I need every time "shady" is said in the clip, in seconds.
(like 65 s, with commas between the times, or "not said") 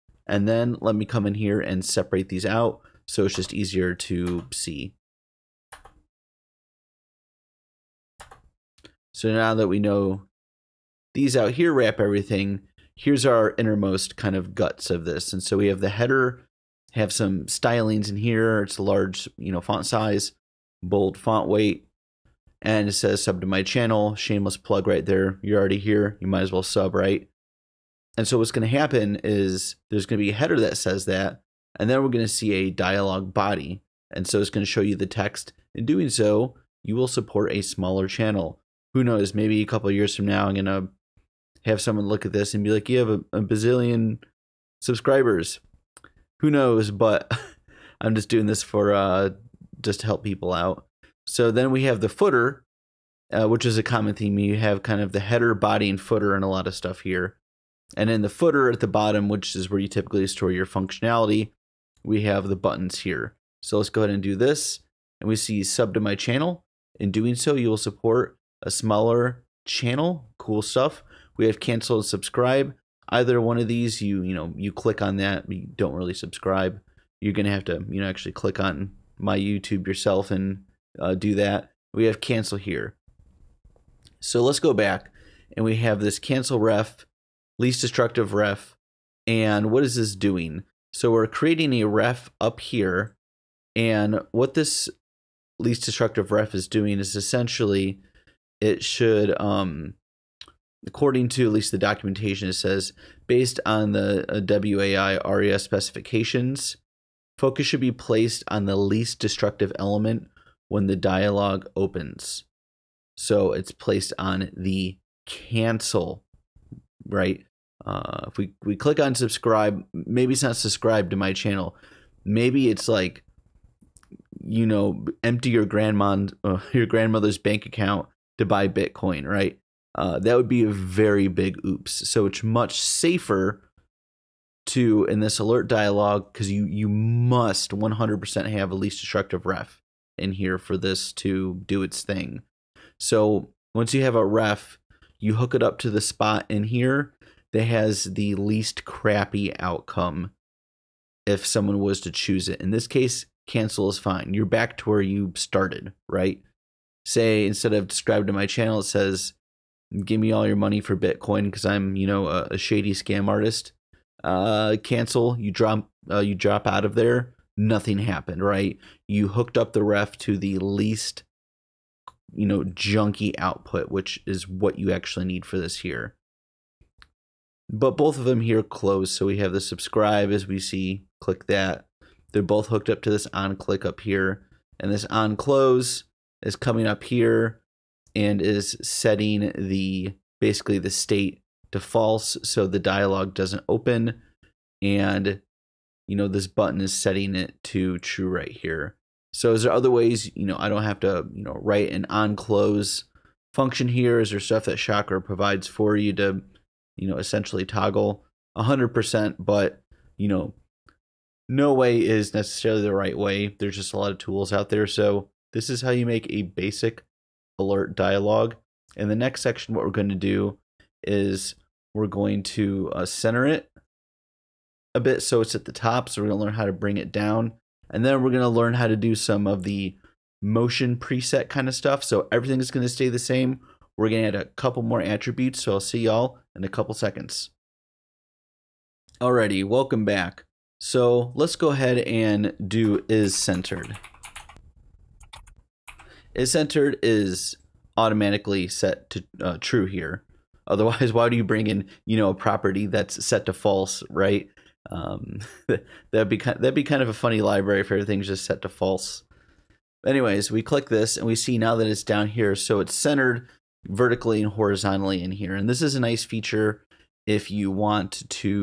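162 s.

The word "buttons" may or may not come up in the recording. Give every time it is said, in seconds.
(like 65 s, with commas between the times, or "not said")
62 s, 196 s.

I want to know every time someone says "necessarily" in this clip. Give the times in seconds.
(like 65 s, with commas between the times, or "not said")
212 s.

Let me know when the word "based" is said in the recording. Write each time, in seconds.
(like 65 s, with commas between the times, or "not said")
103 s.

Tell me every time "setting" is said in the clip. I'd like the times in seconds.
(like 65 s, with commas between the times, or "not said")
188 s, 196 s.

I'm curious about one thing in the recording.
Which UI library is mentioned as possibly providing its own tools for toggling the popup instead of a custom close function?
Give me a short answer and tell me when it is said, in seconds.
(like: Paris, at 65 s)
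Chakra, at 204 s.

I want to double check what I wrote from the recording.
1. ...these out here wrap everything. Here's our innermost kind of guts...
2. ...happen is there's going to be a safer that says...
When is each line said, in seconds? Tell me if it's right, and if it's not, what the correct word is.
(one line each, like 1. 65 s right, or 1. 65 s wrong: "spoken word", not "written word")
1. 11 s right
2. 28 s wrong: "header", not "safer".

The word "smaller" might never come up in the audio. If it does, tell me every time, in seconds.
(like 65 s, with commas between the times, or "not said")
37 s, 68 s.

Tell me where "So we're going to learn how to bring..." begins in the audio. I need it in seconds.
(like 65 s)
226 s.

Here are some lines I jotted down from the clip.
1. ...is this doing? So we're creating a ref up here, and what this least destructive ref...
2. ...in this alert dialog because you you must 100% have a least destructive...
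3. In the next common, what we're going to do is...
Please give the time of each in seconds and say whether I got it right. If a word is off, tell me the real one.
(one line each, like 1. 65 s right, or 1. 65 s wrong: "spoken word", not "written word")
1. 89 s right
2. 135 s right
3. 218 s wrong: "section", not "common".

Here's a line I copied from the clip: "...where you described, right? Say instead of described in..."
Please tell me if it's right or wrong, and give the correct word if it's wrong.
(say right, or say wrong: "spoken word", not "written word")
wrong: "started", not "described".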